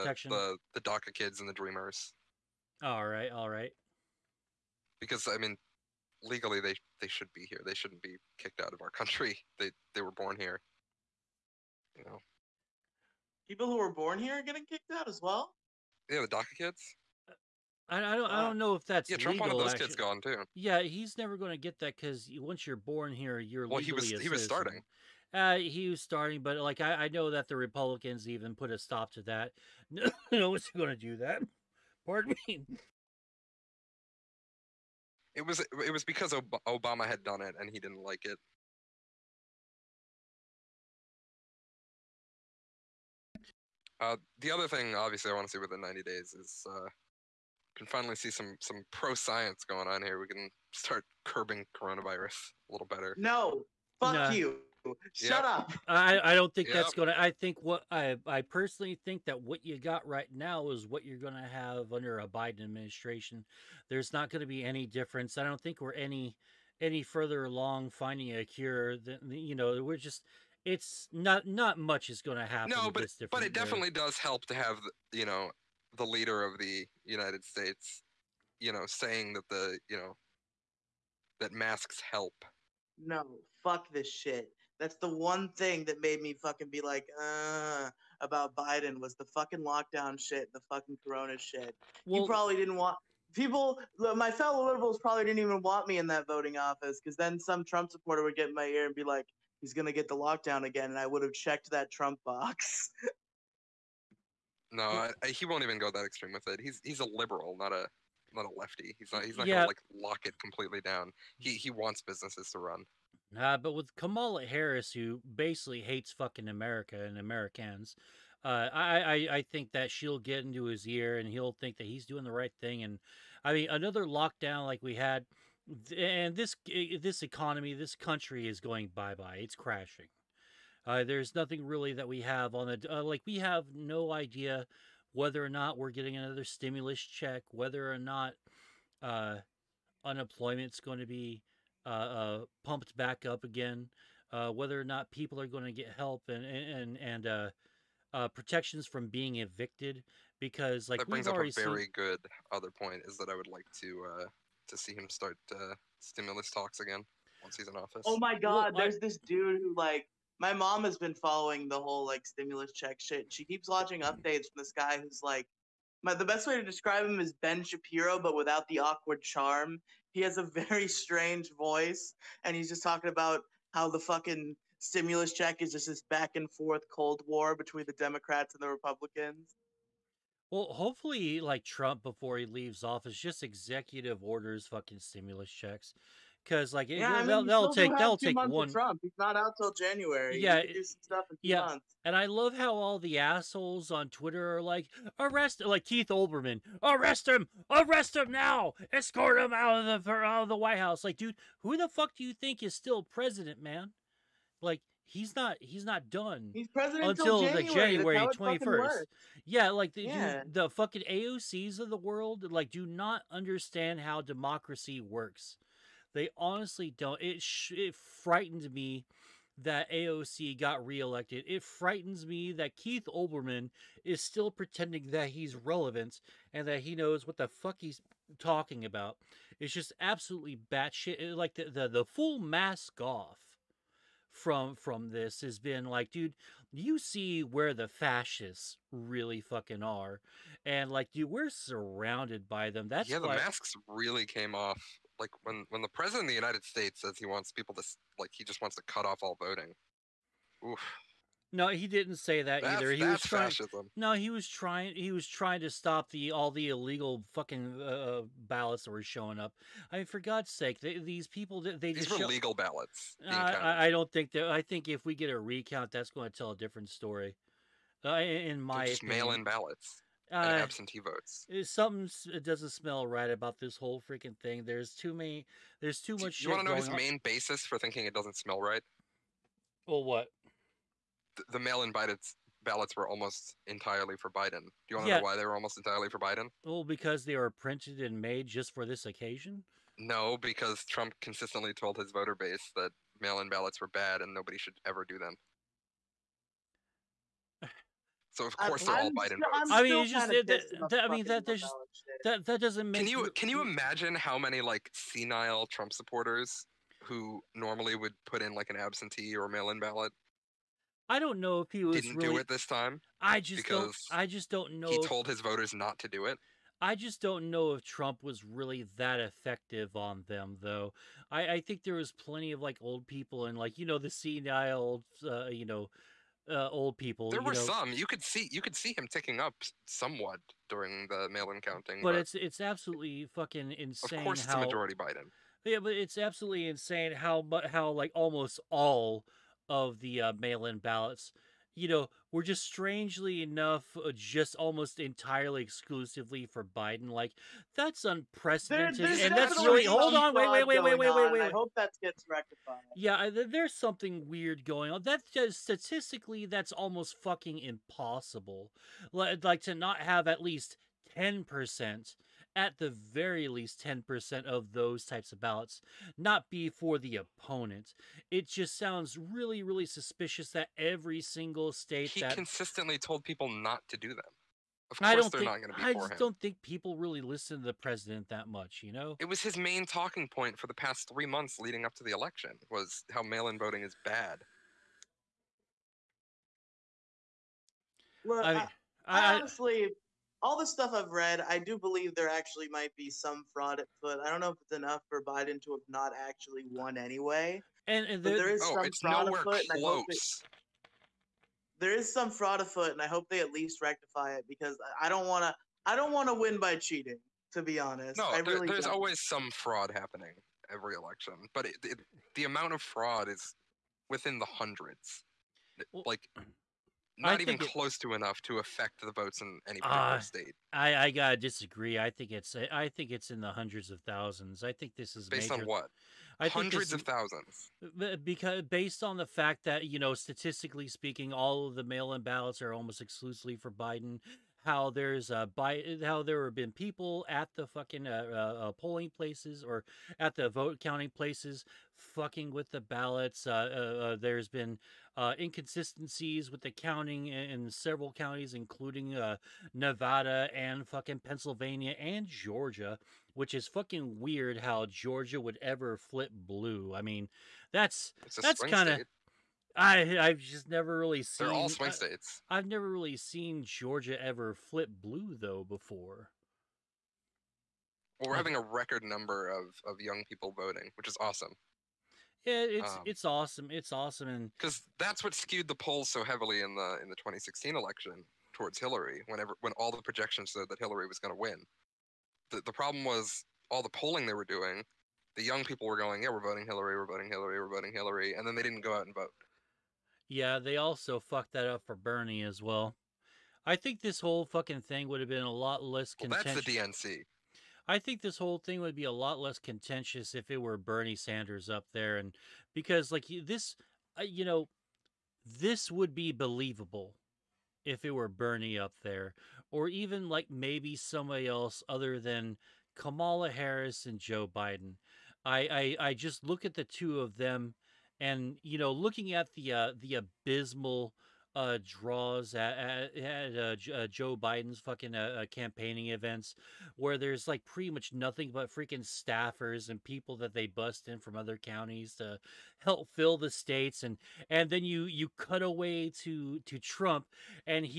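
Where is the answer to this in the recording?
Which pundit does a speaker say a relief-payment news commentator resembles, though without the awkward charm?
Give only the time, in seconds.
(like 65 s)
167 s.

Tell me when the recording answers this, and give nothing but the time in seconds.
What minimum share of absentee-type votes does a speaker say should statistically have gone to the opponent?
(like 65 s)
363 s.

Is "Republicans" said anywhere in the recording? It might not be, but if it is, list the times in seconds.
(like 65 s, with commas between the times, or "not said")
27 s, 178 s.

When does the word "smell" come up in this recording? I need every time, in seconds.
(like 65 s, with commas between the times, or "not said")
272 s, 278 s.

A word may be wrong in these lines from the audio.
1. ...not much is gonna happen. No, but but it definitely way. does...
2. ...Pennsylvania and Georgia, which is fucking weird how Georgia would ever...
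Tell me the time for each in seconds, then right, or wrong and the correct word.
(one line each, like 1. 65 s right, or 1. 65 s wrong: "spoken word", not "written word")
1. 71 s right
2. 451 s right.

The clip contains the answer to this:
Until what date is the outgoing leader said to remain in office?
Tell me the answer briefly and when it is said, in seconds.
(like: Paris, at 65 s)
January 21st, at 207 s.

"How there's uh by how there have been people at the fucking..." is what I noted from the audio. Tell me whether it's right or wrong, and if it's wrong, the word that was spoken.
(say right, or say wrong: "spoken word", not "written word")
right.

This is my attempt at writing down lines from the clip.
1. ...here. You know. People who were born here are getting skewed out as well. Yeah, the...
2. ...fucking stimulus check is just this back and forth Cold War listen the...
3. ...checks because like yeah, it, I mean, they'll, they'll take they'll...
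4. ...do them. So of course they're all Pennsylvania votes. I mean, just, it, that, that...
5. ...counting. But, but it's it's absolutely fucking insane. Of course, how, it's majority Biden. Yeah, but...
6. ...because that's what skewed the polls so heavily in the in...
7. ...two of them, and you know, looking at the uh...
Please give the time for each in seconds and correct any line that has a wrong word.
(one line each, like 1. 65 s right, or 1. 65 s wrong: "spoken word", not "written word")
1. 10 s wrong: "kicked", not "skewed"
2. 173 s wrong: "between", not "listen"
3. 185 s right
4. 295 s wrong: "Biden", not "Pennsylvania"
5. 331 s right
6. 474 s right
7. 516 s right.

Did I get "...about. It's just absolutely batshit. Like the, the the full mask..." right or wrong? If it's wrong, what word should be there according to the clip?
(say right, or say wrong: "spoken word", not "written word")
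right.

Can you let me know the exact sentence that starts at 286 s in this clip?
Well, oh, because they were printed and made just for this occasion.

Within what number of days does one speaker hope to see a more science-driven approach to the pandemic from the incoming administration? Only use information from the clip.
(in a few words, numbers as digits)
90.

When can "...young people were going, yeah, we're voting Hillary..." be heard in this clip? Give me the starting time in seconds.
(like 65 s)
485 s.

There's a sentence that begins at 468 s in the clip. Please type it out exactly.
Well, we're having a record number of, of young people voting, which is awesome.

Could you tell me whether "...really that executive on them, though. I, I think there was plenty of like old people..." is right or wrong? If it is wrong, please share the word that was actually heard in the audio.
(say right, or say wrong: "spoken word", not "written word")
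wrong: "effective", not "executive".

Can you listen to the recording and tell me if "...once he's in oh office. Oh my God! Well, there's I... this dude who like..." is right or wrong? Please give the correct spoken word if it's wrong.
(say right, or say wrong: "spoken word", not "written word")
right.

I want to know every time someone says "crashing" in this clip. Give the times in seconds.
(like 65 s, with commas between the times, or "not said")
129 s.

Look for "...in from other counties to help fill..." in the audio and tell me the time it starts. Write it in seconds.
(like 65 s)
531 s.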